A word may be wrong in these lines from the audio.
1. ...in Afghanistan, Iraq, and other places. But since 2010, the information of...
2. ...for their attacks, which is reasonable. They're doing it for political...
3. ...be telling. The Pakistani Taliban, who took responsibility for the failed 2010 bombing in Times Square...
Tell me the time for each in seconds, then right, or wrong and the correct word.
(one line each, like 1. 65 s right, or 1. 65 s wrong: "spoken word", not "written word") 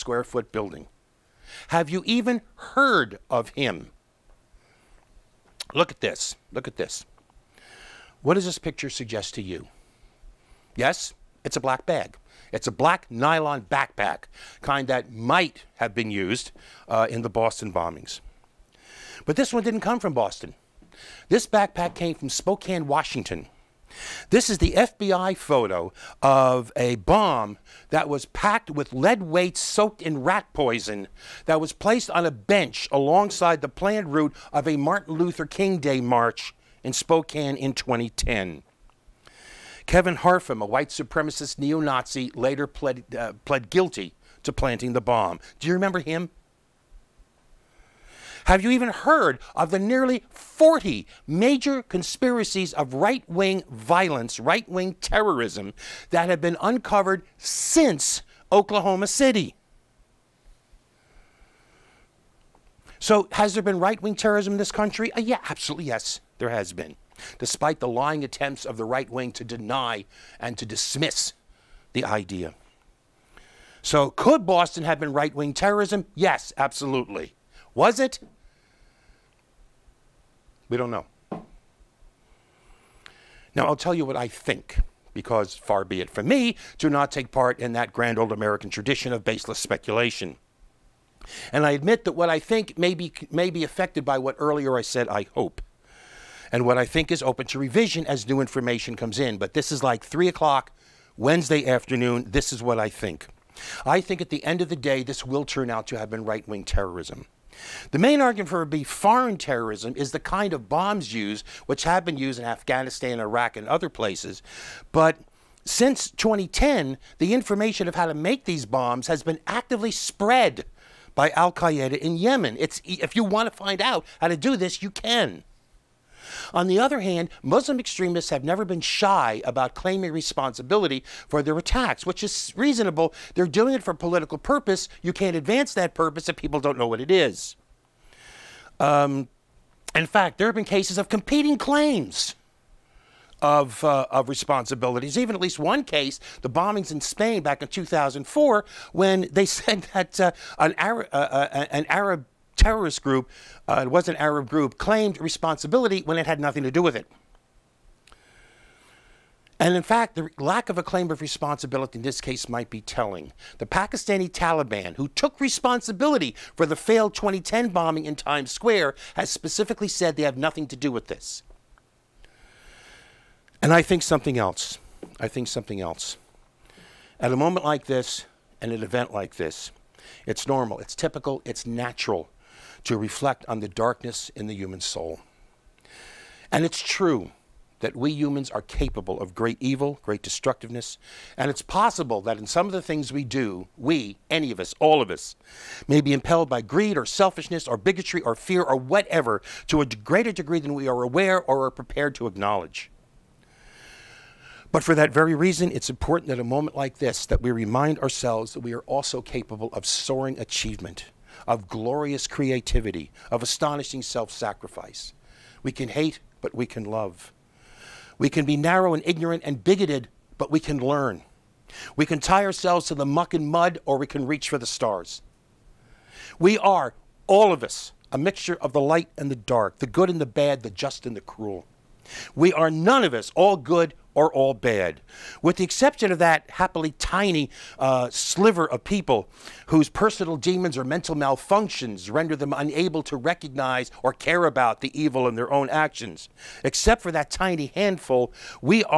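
1. 112 s right
2. 131 s right
3. 162 s right.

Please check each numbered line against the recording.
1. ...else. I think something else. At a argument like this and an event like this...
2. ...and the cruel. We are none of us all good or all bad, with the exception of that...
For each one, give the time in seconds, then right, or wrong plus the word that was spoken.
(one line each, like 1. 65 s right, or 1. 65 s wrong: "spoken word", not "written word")
1. 174 s wrong: "moment", not "argument"
2. 231 s right.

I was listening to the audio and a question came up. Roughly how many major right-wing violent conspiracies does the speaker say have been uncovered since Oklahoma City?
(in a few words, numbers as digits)
nearly 40.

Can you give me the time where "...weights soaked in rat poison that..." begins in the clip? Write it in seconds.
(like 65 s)
29 s.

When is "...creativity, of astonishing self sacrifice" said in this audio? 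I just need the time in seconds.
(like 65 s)
212 s.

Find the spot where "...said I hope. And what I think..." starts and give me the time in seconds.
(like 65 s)
94 s.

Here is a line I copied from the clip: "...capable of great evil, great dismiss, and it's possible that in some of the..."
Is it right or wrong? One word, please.
wrong.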